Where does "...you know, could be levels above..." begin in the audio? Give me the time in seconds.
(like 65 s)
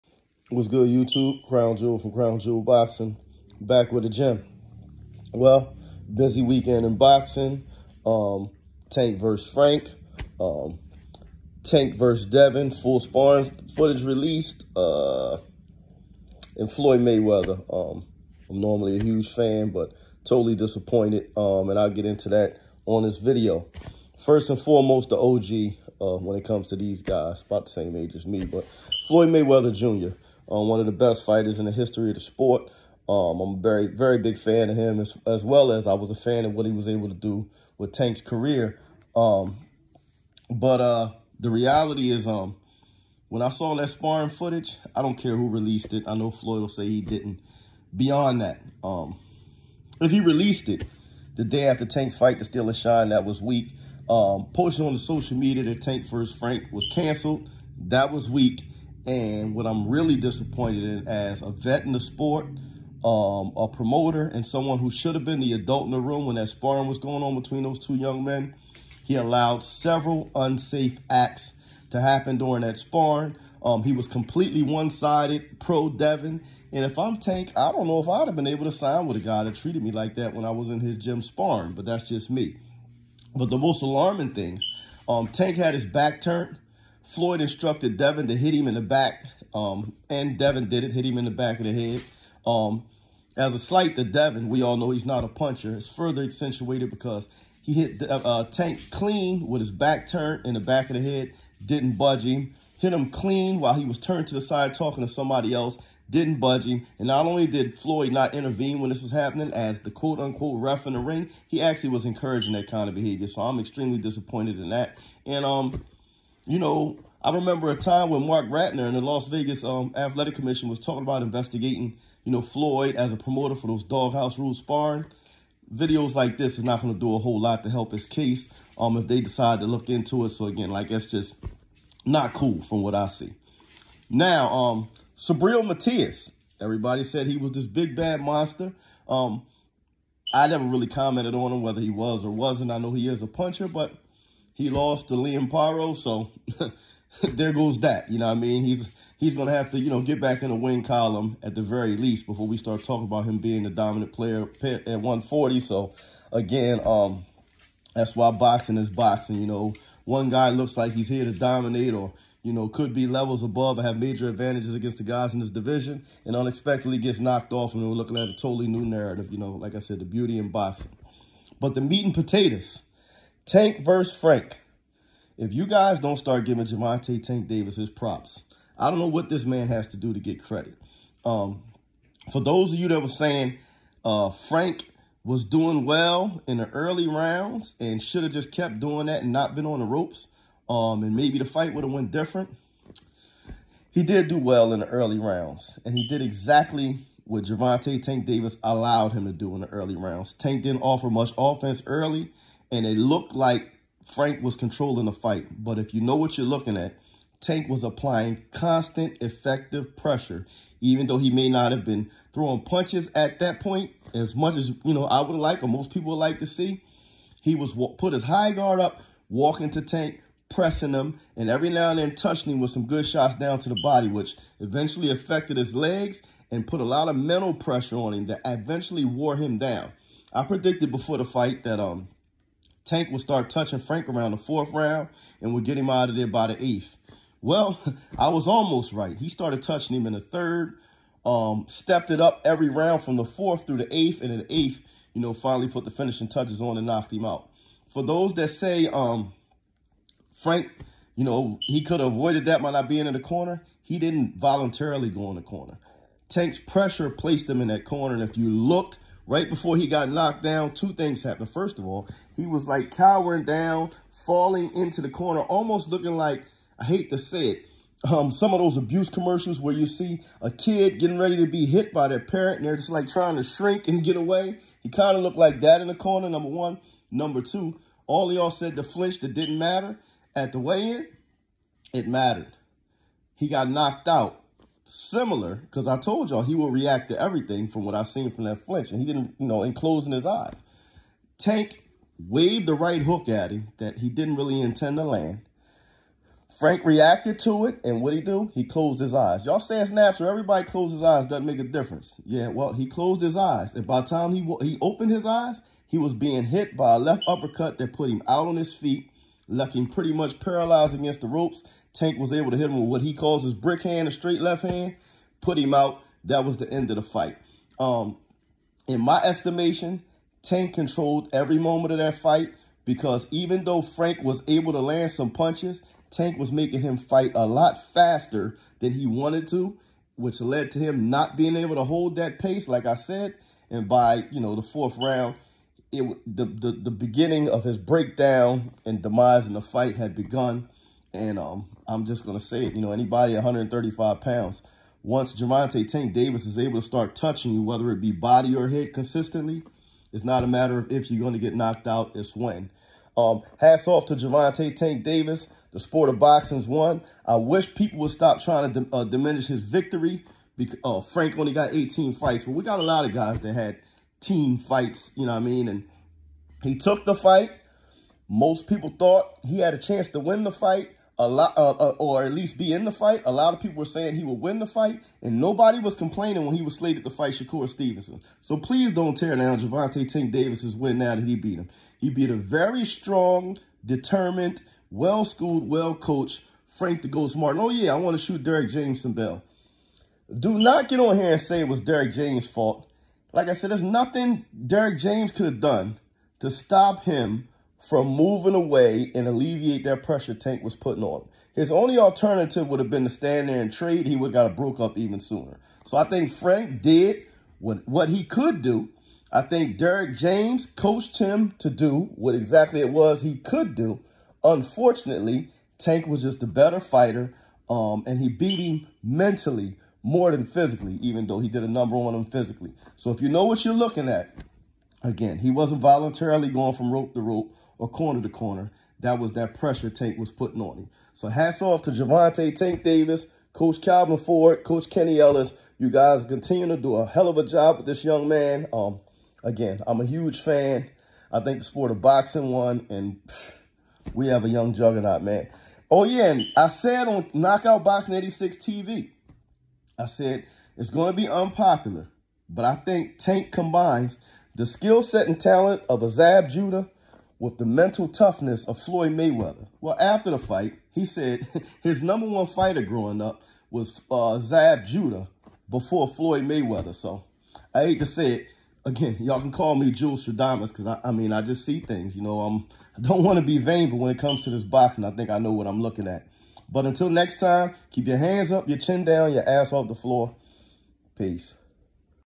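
162 s.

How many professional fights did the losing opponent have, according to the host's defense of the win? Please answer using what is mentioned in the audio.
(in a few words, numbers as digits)
18.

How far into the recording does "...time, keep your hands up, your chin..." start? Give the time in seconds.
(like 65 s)
477 s.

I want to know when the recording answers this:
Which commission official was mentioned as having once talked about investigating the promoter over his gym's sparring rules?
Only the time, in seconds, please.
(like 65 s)
118 s.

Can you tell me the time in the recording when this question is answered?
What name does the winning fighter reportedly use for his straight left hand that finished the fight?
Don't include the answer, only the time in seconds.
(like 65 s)
313 s.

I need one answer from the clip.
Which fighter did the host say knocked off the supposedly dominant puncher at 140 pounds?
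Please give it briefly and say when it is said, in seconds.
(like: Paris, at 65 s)
Liam Paro, at 145 s.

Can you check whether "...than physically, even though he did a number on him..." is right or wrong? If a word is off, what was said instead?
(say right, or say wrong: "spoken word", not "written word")
right.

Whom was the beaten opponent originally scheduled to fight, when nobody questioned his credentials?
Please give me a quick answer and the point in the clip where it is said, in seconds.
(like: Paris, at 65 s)
Shakur Stevenson, at 377 s.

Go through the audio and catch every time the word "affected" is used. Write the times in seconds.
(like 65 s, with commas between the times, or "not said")
225 s.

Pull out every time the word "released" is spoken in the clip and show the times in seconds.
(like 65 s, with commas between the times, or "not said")
14 s, 45 s, 50 s.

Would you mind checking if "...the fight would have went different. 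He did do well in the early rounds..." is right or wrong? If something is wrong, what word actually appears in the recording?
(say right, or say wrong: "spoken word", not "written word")
right.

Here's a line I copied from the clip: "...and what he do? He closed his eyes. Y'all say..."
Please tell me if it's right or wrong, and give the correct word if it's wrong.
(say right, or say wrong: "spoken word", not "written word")
right.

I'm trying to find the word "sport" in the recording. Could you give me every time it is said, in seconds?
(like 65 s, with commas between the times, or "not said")
32 s, 61 s, 355 s, 441 s.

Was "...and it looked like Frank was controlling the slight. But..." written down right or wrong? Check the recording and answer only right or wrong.
wrong.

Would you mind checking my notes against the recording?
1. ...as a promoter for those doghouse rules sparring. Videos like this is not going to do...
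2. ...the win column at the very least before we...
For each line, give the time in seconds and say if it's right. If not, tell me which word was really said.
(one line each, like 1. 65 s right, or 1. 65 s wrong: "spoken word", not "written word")
1. 122 s right
2. 150 s right.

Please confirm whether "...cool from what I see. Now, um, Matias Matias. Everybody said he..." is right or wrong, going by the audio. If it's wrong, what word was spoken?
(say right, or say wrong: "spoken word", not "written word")
wrong: "Subriel", not "Matias".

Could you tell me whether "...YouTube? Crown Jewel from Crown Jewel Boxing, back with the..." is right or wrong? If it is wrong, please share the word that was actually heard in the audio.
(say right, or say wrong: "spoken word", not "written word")
right.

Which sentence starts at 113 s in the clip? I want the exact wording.
So I'm extremely disappointed in that.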